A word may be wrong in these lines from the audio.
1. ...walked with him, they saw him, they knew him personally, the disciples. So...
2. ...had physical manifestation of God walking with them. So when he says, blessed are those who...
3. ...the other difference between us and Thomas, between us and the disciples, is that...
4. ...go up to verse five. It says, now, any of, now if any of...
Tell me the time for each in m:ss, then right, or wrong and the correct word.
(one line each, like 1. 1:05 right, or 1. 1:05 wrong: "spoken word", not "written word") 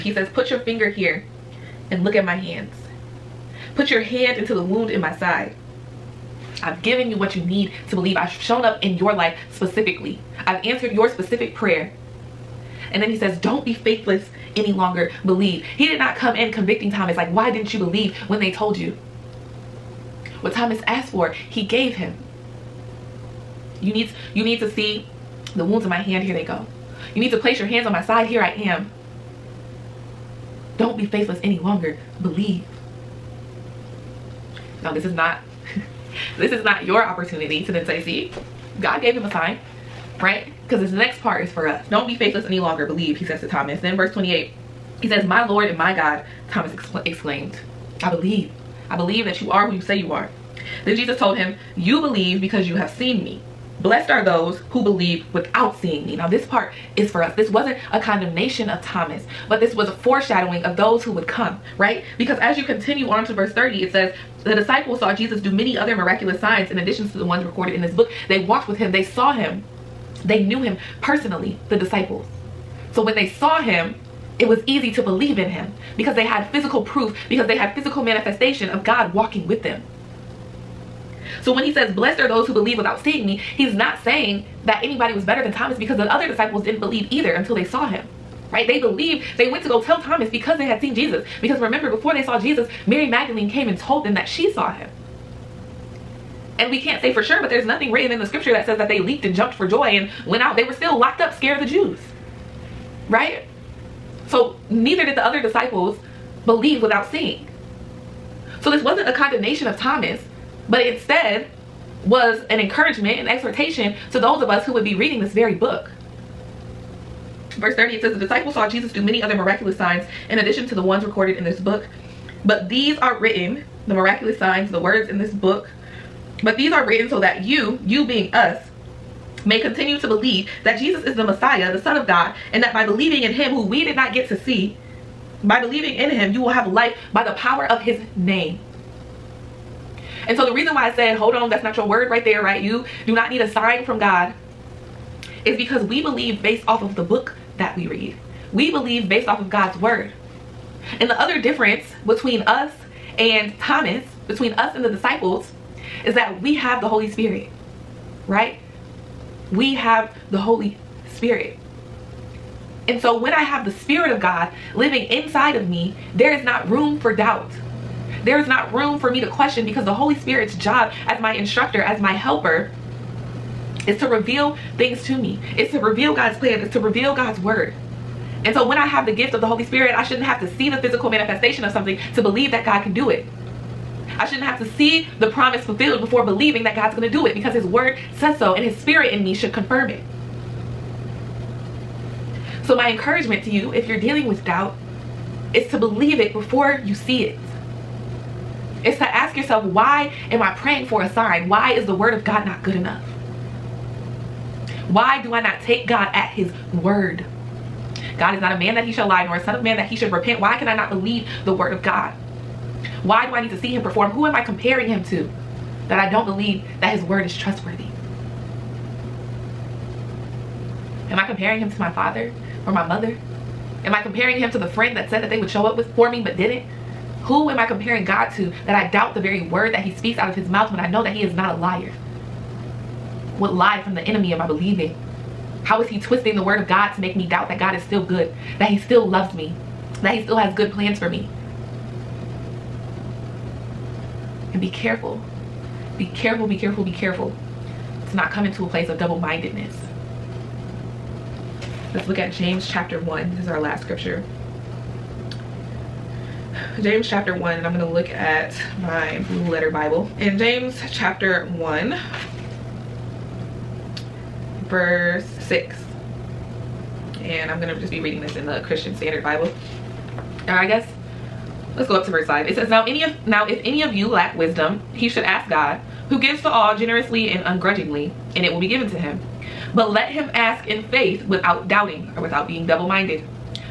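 1. 1:08 right
2. 1:17 right
3. 2:31 right
4. 4:31 right.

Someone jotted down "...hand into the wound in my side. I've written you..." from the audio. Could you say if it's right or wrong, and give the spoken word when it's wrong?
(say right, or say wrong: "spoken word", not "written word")
wrong: "given", not "written".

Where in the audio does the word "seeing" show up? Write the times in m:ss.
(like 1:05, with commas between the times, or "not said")
0:55, 1:23, 1:47.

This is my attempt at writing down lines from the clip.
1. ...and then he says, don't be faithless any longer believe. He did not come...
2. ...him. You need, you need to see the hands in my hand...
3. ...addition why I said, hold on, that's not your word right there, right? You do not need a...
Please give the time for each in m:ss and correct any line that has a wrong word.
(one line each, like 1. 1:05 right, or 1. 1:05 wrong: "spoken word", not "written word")
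1. 0:12 right
2. 0:21 wrong: "wounds", not "hands"
3. 2:20 wrong: "reason", not "addition".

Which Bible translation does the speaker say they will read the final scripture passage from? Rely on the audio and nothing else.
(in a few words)
Christian Standard Bible.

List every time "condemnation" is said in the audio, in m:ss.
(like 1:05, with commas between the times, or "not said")
0:57, 1:49.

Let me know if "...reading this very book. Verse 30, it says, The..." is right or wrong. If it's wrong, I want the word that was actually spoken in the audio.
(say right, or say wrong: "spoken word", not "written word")
right.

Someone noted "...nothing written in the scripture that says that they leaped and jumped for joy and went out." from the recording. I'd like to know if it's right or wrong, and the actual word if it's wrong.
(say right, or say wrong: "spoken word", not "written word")
right.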